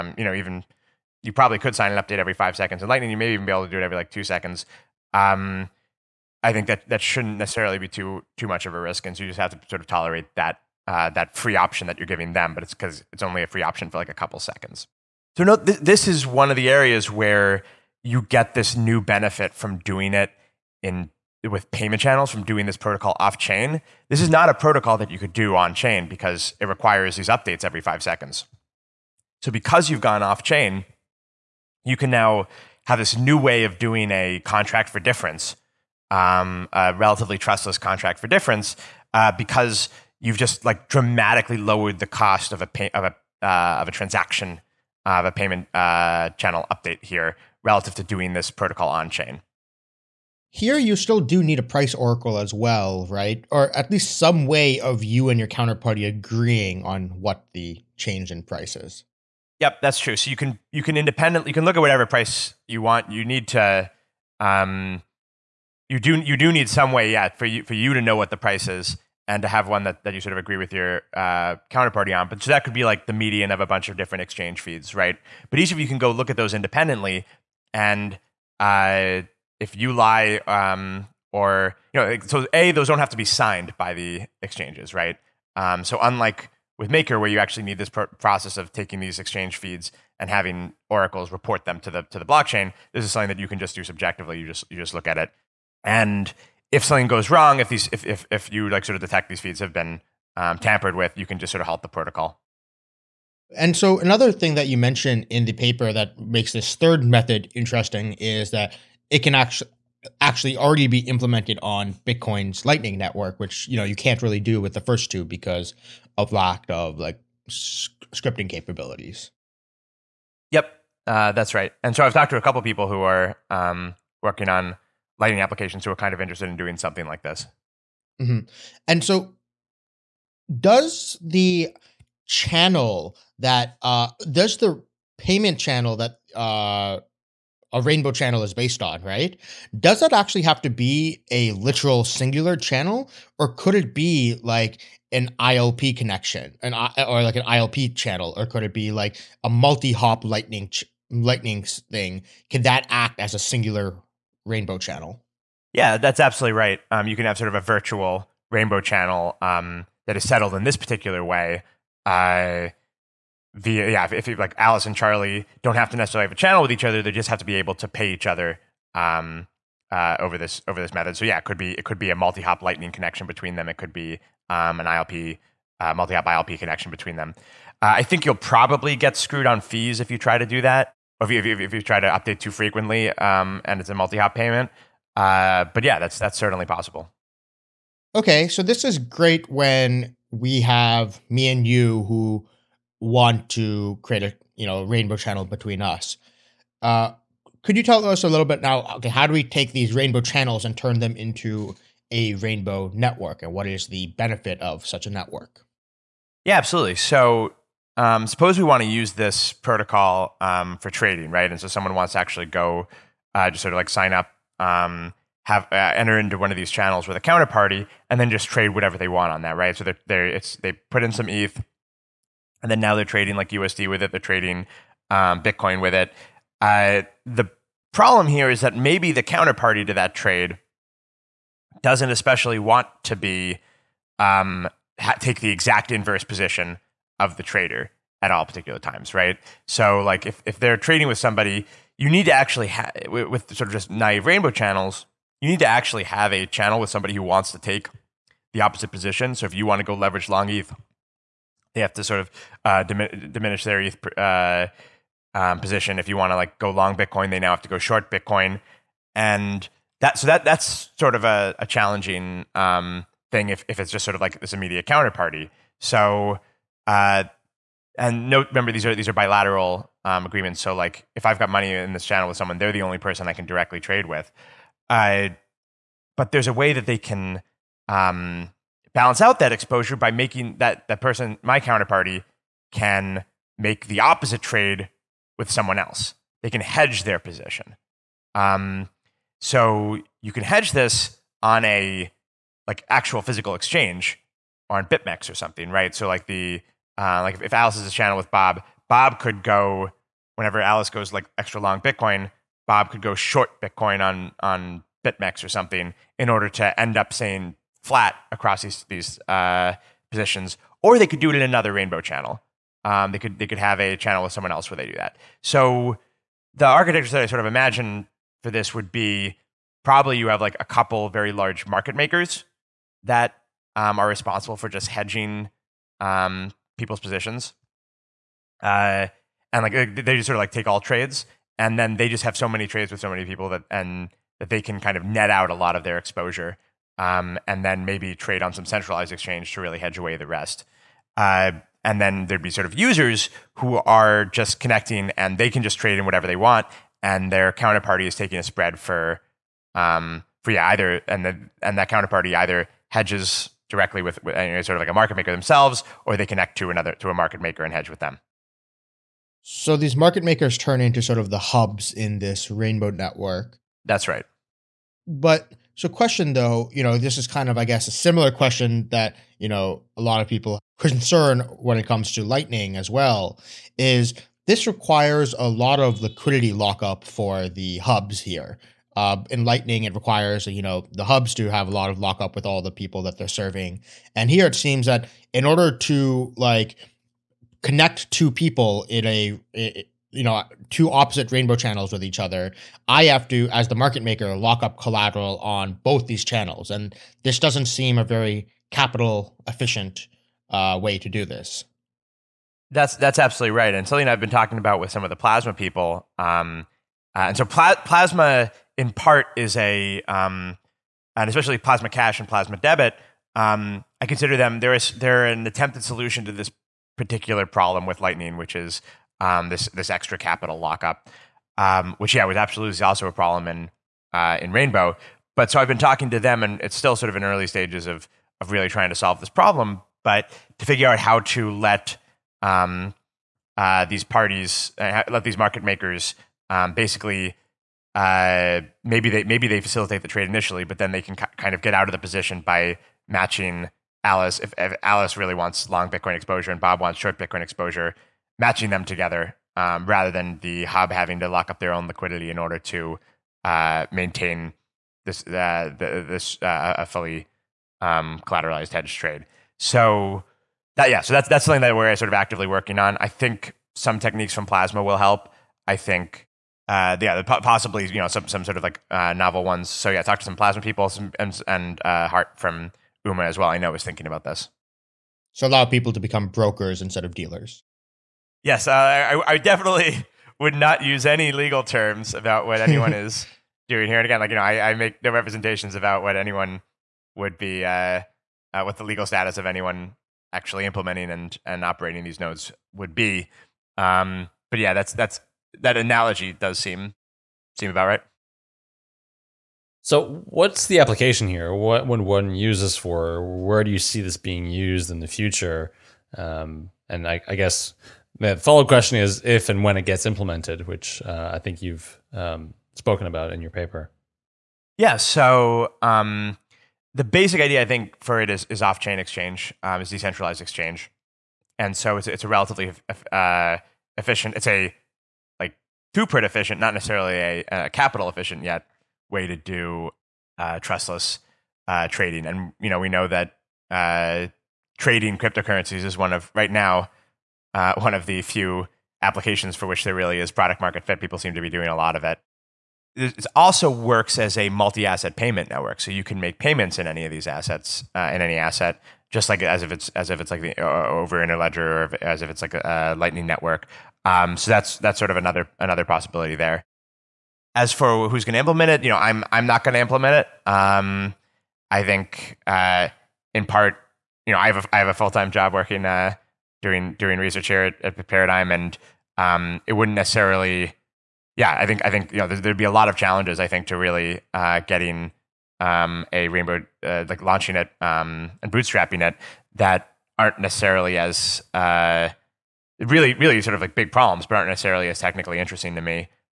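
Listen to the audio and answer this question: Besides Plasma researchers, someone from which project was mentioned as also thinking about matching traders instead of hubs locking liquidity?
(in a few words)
UMA.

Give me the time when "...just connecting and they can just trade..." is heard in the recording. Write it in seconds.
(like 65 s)
344 s.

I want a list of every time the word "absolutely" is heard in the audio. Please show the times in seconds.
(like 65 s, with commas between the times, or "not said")
156 s, 206 s, 403 s, 422 s.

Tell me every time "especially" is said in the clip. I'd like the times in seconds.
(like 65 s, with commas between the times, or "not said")
232 s, 411 s.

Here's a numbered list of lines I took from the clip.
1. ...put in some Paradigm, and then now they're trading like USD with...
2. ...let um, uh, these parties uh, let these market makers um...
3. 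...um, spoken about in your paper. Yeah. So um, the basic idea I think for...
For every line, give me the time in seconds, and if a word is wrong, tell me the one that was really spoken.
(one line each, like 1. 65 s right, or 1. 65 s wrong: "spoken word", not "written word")
1. 220 s wrong: "ETH", not "Paradigm"
2. 431 s right
3. 512 s right.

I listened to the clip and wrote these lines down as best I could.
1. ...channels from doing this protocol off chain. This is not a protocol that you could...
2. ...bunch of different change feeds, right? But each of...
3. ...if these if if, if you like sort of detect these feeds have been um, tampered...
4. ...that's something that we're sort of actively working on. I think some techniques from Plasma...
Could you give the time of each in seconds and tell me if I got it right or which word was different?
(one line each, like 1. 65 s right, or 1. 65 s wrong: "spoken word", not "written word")
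1. 21 s right
2. 73 s wrong: "exchange", not "change"
3. 97 s right
4. 461 s right.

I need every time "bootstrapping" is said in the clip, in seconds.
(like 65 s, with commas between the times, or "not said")
578 s.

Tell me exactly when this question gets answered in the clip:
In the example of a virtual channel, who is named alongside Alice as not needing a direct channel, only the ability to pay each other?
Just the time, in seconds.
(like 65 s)
164 s.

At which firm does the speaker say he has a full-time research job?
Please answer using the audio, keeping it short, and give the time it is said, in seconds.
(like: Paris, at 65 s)
Paradigm, at 568 s.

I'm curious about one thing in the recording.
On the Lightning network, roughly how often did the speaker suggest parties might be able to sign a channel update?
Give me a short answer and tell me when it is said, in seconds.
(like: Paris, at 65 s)
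every 2 seconds, at 3 s.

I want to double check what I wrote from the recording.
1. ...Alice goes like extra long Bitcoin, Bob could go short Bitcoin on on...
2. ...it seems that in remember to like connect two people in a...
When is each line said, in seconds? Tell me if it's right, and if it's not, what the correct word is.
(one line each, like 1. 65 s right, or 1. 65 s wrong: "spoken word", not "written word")
1. 300 s right
2. 384 s wrong: "order", not "remember".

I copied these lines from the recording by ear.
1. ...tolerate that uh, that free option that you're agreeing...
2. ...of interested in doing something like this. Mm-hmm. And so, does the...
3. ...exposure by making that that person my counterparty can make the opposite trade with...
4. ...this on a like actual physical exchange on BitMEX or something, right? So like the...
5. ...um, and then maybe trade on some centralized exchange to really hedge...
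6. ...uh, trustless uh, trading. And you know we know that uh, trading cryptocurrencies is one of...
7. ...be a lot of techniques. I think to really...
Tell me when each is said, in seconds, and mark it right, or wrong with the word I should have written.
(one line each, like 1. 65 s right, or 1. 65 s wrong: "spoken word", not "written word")
1. 9 s wrong: "giving", not "agreeing"
2. 126 s right
3. 279 s right
4. 290 s right
5. 337 s right
6. 530 s right
7. 572 s wrong: "challenges", not "techniques".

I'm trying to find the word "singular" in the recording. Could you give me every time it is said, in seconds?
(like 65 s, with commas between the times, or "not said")
142 s, 153 s.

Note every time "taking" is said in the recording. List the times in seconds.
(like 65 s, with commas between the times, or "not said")
88 s, 348 s.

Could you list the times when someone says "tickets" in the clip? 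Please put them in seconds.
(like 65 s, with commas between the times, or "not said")
not said.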